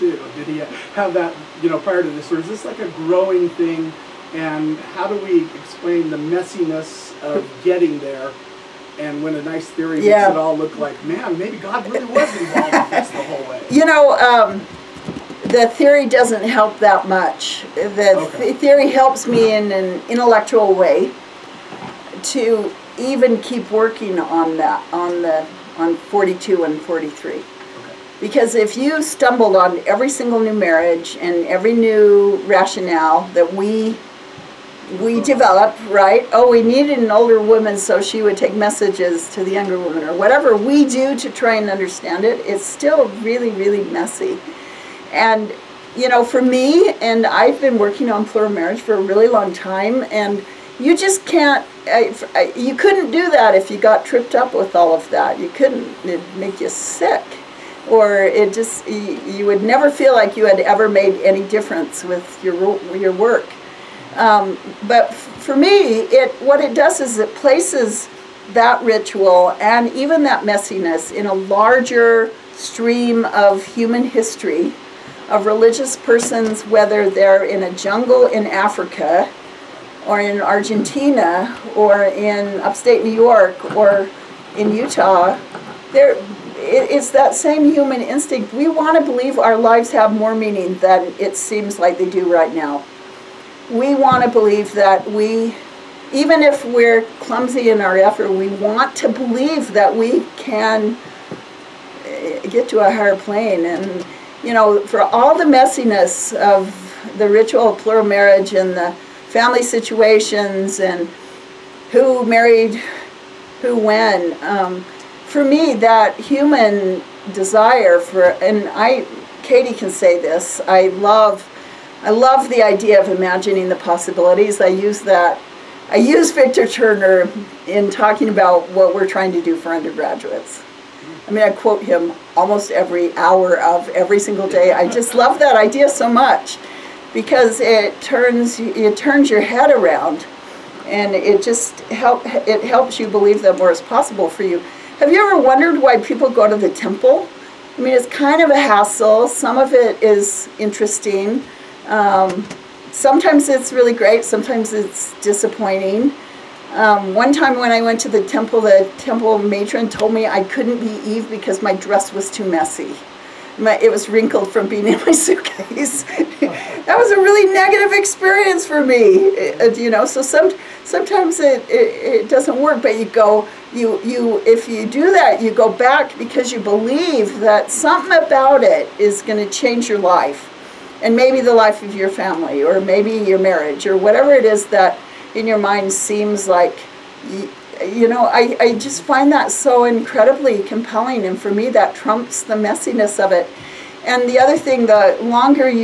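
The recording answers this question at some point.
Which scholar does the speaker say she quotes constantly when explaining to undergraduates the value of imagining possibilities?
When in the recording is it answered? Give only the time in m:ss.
2:06.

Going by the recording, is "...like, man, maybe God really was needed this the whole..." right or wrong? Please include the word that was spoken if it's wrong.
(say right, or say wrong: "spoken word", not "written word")
wrong: "involved", not "needed".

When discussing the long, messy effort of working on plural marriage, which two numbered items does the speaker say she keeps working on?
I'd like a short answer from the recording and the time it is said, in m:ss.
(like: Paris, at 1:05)
42 and 43, at 0:25.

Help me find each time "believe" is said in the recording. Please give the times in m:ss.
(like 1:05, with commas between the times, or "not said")
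1:29, 1:34, 1:39, 2:23, 2:56.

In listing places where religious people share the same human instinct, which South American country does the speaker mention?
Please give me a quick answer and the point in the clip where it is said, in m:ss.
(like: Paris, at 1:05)
Argentina, at 1:20.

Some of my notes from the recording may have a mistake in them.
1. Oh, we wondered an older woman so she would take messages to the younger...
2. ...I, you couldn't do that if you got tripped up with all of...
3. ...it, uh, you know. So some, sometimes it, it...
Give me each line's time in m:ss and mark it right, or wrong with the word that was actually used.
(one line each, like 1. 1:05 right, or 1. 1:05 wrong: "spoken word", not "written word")
1. 0:36 wrong: "needed", not "wondered"
2. 0:52 right
3. 2:48 right.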